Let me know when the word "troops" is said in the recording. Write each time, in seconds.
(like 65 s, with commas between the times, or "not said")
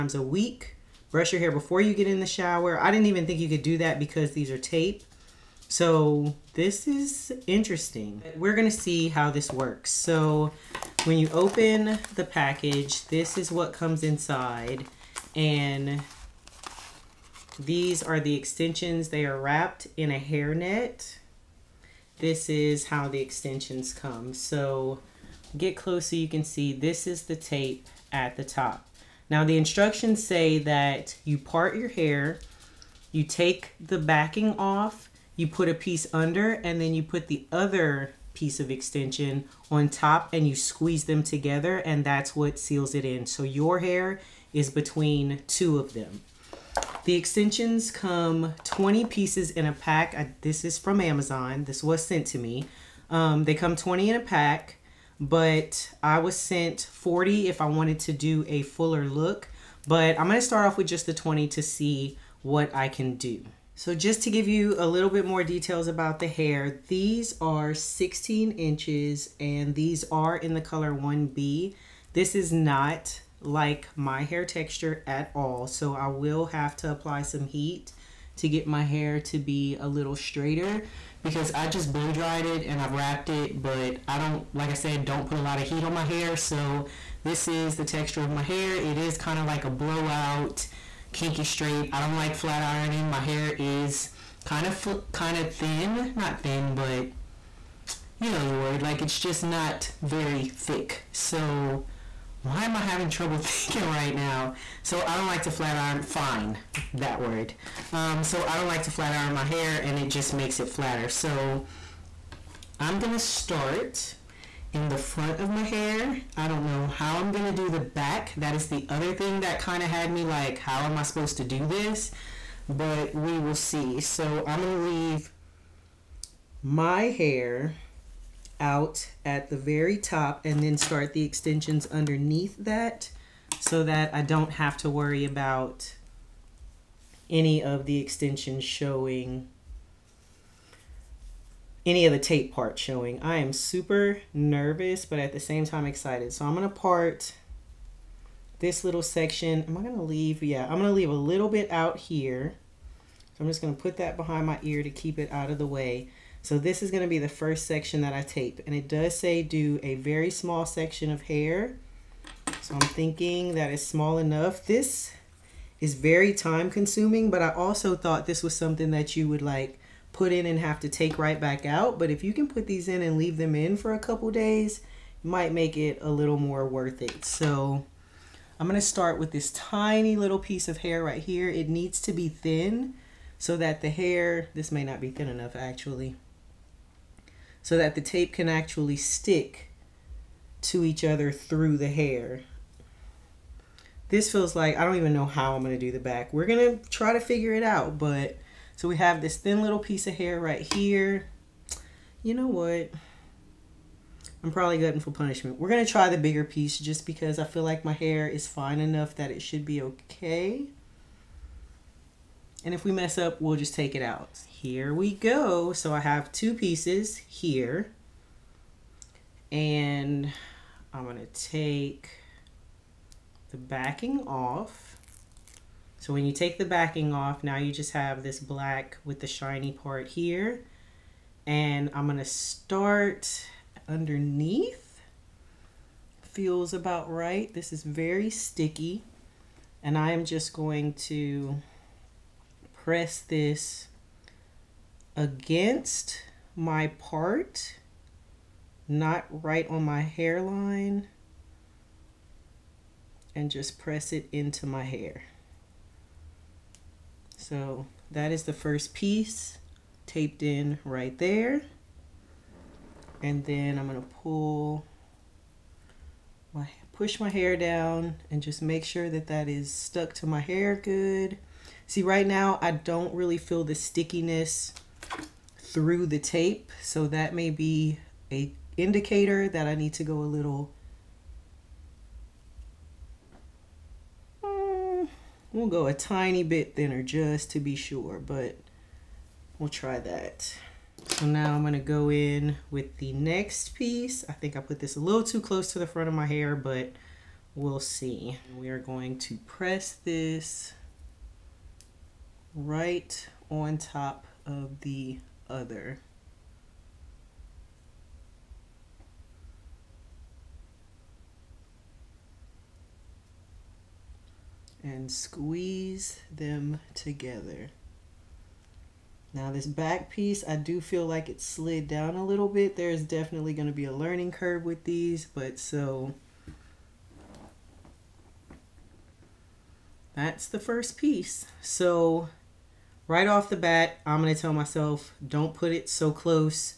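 not said.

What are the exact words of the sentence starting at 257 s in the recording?
So that is the first piece taped in right there.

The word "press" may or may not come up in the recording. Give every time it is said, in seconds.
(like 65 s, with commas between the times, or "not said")
242 s, 253 s, 299 s.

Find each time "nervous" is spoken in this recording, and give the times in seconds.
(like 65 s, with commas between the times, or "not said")
144 s.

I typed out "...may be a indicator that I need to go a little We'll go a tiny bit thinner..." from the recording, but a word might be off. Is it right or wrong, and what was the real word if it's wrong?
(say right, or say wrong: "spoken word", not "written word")
right.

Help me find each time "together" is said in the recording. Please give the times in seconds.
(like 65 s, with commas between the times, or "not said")
41 s, 316 s.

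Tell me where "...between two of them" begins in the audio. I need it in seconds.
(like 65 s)
44 s.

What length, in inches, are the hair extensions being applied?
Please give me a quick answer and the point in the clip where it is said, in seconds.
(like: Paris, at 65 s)
16 inches, at 67 s.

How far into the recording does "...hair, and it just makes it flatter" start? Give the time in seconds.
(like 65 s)
109 s.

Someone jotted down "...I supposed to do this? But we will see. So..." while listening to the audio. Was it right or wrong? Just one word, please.
right.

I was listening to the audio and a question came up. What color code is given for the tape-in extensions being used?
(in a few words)
1B.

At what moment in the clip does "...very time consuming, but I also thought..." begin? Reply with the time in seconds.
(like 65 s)
165 s.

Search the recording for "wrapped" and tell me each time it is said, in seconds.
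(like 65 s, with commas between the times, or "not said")
19 s, 82 s.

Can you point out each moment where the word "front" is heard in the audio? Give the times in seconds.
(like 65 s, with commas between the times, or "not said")
114 s, 295 s.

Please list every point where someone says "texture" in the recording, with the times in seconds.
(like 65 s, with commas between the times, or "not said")
74 s, 87 s.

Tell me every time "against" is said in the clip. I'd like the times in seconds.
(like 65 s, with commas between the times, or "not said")
245 s.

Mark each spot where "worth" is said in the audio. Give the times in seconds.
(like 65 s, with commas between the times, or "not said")
176 s.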